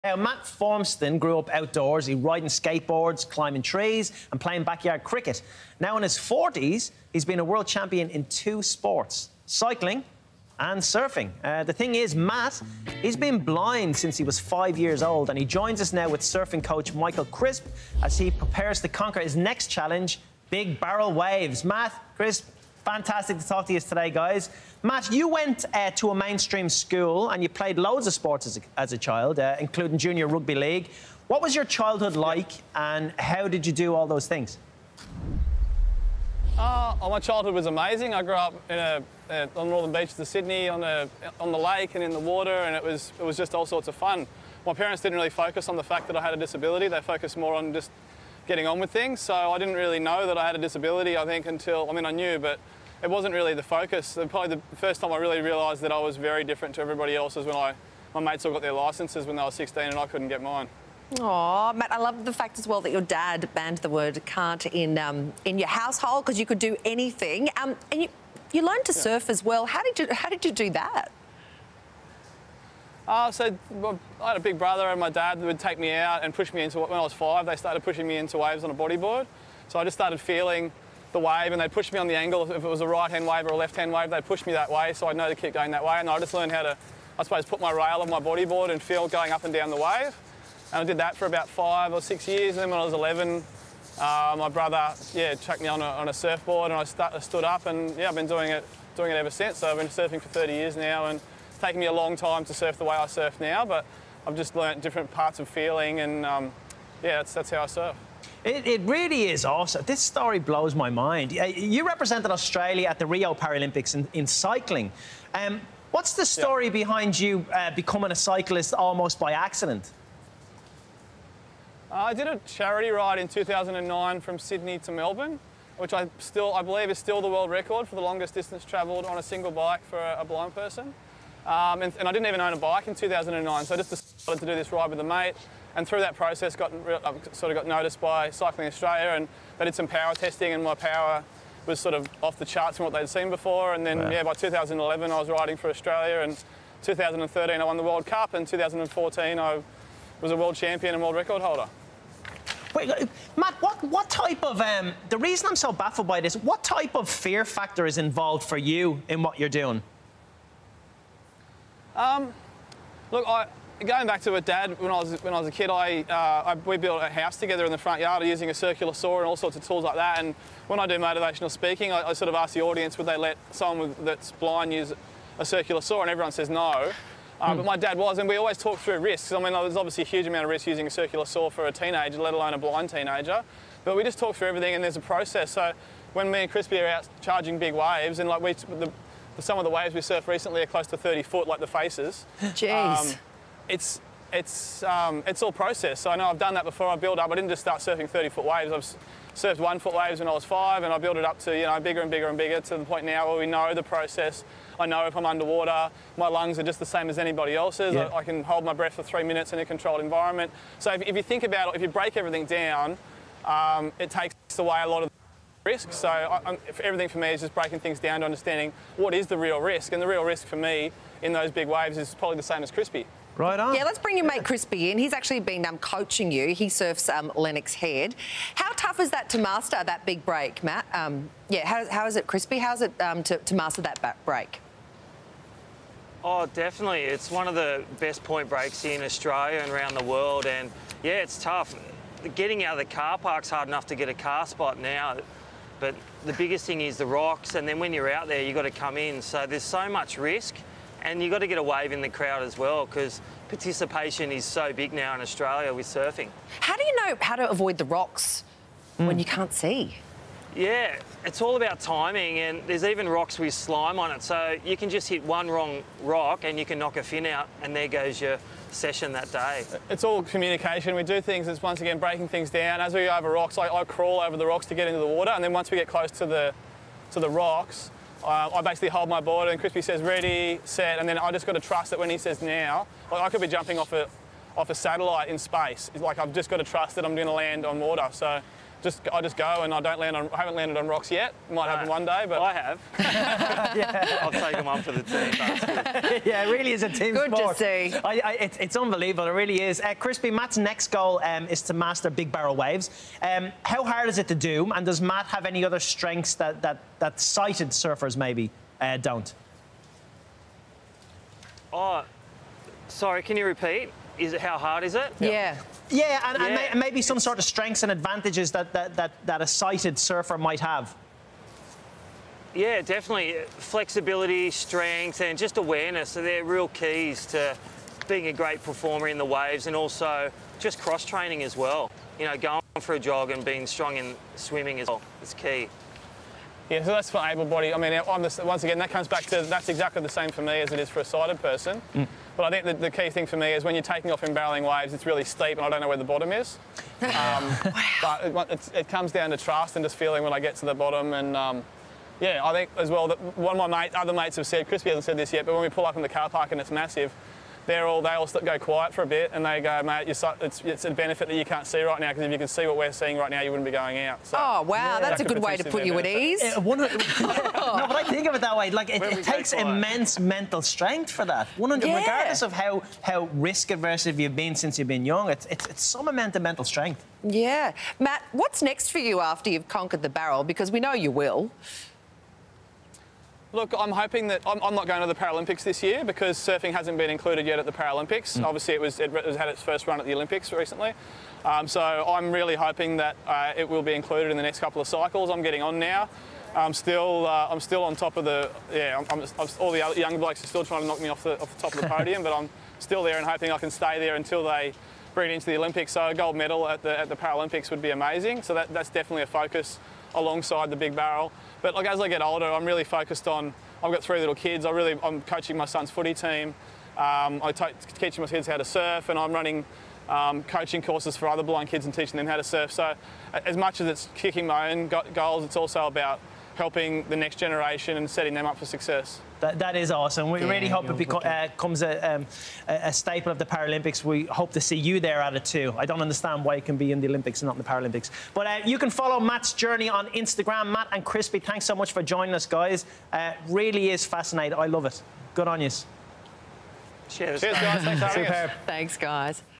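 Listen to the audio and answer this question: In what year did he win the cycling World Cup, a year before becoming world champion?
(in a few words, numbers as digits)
2013.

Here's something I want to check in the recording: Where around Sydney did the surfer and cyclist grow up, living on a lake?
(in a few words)
Northern beaches of Sydney.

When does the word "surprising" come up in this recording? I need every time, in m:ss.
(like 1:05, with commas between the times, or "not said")
not said.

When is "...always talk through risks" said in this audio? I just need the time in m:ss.
2:58.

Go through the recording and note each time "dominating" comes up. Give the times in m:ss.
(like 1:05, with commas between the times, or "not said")
not said.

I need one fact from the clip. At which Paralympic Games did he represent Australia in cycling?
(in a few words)
Rio.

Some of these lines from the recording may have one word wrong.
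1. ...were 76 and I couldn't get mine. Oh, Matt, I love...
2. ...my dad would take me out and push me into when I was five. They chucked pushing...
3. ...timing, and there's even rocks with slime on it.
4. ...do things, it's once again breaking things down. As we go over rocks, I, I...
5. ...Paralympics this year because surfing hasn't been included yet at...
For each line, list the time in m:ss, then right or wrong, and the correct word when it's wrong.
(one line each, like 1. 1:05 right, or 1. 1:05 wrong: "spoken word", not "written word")
1. 0:59 wrong: "16", not "76"
2. 1:14 wrong: "started", not "chucked"
3. 4:21 right
4. 4:31 right
5. 6:25 right.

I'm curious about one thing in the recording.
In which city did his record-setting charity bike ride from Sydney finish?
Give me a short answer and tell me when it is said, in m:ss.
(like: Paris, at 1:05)
Melbourne, at 2:04.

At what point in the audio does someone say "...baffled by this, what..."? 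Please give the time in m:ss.
2:35.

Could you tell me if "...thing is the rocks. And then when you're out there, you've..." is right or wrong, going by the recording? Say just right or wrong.
right.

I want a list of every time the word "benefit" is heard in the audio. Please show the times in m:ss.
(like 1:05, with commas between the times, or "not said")
6:00, 6:05.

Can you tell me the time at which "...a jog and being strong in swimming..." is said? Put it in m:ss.
5:32.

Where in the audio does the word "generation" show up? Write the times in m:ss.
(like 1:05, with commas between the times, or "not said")
7:07.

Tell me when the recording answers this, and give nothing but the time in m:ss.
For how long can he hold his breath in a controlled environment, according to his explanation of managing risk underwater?
3:29.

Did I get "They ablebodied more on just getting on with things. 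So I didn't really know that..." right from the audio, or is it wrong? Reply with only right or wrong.
wrong.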